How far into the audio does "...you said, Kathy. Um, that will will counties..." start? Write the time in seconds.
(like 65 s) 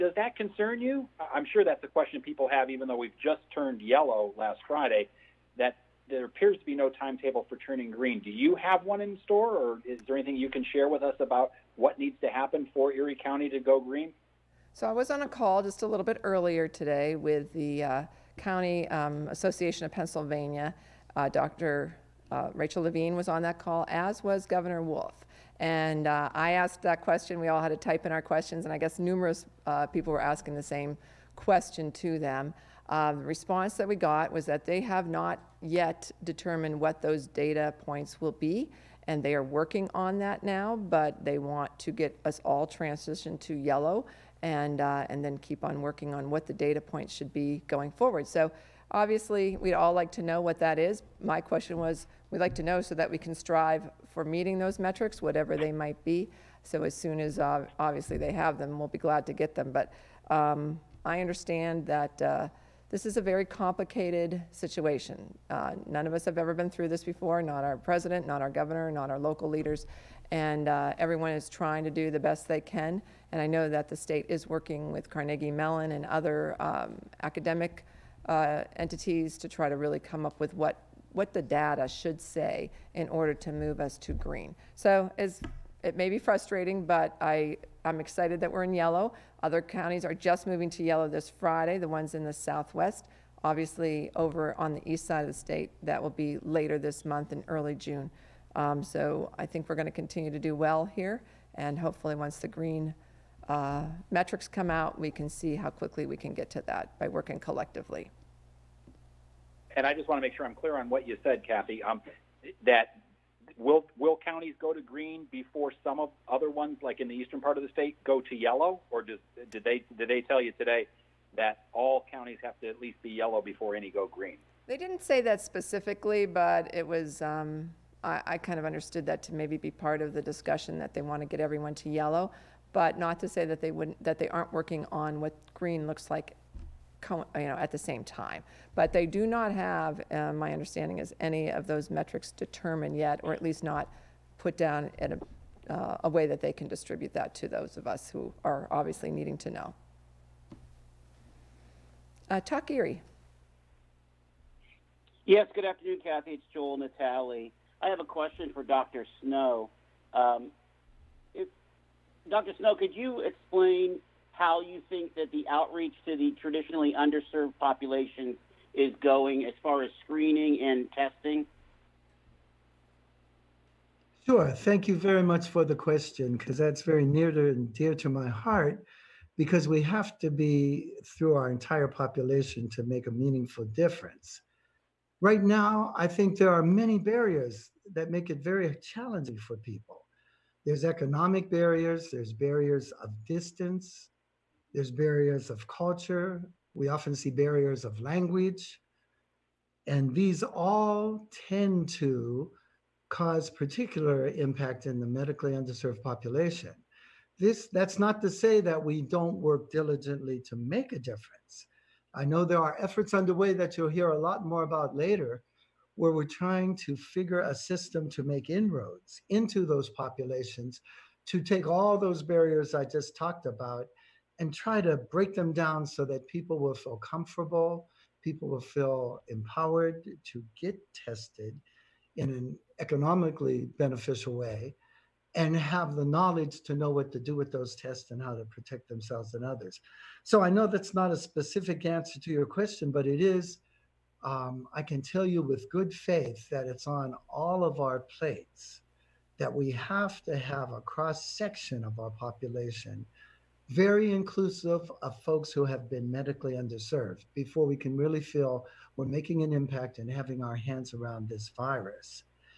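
111 s.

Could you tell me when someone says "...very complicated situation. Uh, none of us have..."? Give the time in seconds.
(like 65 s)
63 s.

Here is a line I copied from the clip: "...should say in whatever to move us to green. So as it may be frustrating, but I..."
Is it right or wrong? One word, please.
wrong.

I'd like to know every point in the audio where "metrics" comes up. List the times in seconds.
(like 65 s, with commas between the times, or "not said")
54 s, 104 s, 141 s.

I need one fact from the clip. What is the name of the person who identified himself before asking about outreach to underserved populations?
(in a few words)
Joel Natalie.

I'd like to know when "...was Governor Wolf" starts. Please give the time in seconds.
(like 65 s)
24 s.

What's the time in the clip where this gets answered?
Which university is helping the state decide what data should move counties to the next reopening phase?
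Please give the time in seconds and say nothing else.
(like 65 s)
75 s.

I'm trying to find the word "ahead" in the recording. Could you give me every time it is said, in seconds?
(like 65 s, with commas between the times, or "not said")
not said.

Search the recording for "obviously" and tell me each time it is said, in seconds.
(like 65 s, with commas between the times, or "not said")
48 s, 57 s, 93 s, 148 s.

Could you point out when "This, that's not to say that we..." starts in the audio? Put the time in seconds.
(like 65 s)
207 s.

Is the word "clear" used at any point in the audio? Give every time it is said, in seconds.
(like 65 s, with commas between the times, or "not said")
110 s.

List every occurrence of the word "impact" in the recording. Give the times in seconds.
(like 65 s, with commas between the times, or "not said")
204 s, 259 s.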